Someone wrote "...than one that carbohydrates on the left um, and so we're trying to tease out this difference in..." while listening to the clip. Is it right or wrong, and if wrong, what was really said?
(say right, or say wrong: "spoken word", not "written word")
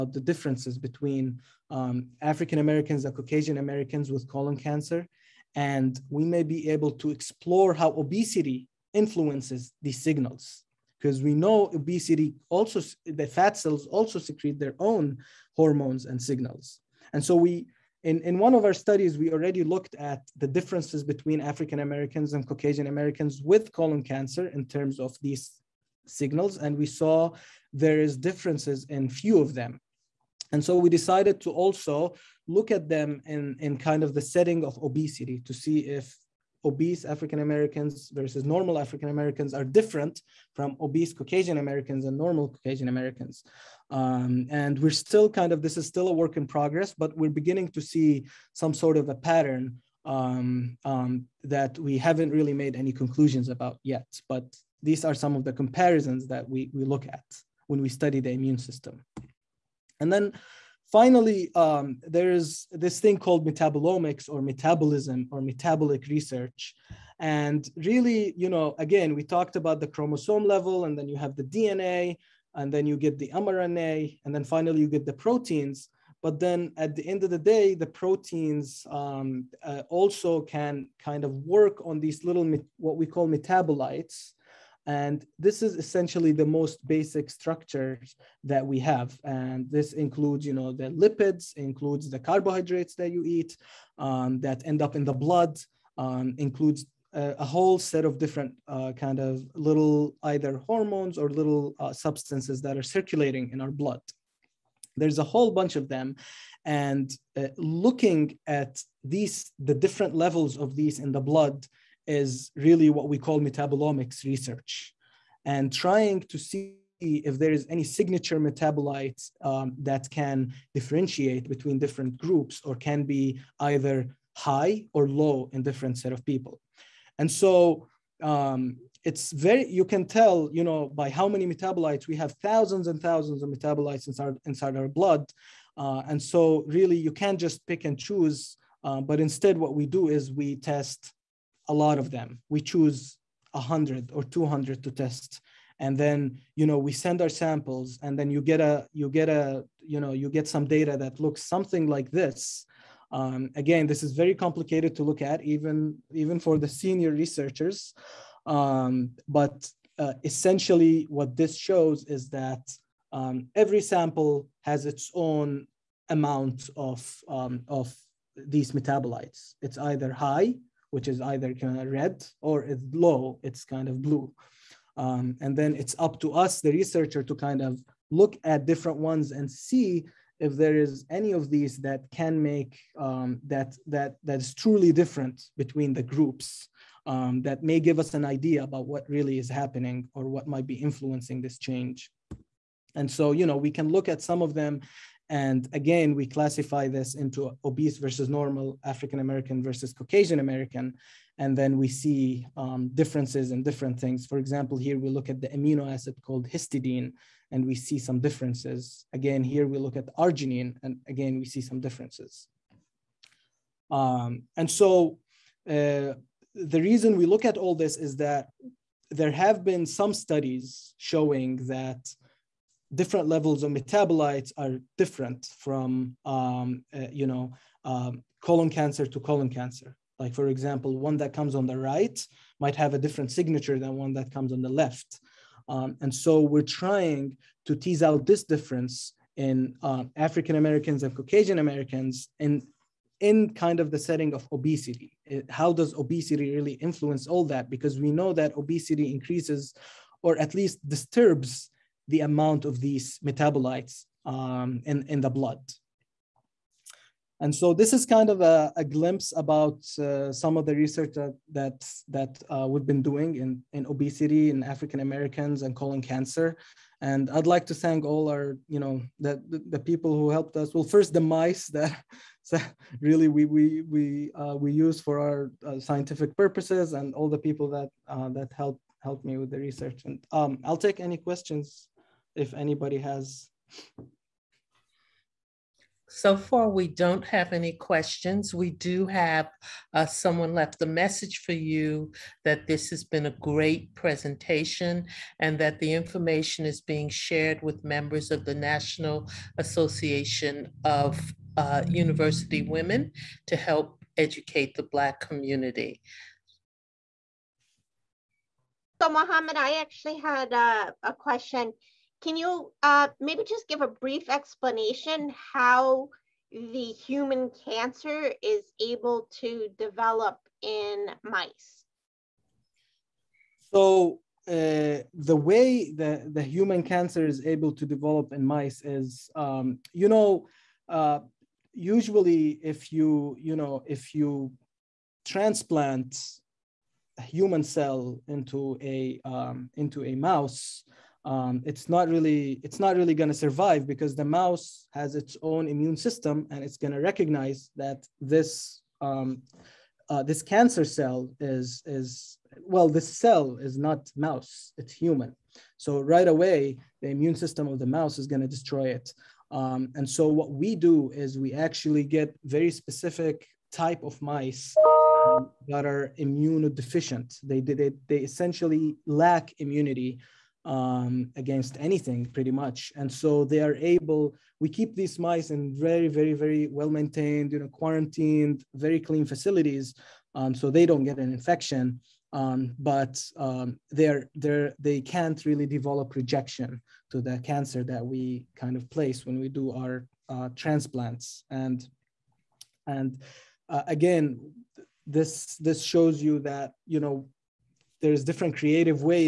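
wrong: "comes", not "carbohydrates".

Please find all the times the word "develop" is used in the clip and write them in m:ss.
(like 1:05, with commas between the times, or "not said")
5:19, 5:27, 6:25.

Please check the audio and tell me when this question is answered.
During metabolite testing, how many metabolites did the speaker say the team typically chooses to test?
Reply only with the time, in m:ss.
2:23.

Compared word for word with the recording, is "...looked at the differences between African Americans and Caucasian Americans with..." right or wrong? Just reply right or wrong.
right.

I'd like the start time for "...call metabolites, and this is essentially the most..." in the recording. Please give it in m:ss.
1:23.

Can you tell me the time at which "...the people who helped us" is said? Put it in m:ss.
4:29.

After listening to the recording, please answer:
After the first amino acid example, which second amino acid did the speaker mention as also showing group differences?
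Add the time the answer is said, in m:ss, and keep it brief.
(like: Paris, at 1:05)
arginine, at 3:30.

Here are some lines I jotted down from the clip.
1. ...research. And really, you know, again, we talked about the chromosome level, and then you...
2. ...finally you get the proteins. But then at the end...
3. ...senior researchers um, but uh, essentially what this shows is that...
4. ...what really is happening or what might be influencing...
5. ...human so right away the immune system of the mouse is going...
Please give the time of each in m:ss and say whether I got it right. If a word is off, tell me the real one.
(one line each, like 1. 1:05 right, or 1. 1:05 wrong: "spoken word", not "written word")
1. 1:06 right
2. 1:14 right
3. 2:36 right
4. 3:08 right
5. 5:54 right.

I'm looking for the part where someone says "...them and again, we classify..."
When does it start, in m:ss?
3:14.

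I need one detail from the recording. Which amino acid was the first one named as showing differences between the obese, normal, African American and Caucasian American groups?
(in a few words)
histidine.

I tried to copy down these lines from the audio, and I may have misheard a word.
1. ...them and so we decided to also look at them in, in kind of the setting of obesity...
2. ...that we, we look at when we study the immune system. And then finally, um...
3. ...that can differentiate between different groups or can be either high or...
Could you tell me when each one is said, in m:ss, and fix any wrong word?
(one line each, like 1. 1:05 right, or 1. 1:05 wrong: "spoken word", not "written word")
1. 0:29 right
2. 0:56 right
3. 1:59 right.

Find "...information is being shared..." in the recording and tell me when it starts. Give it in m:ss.
4:55.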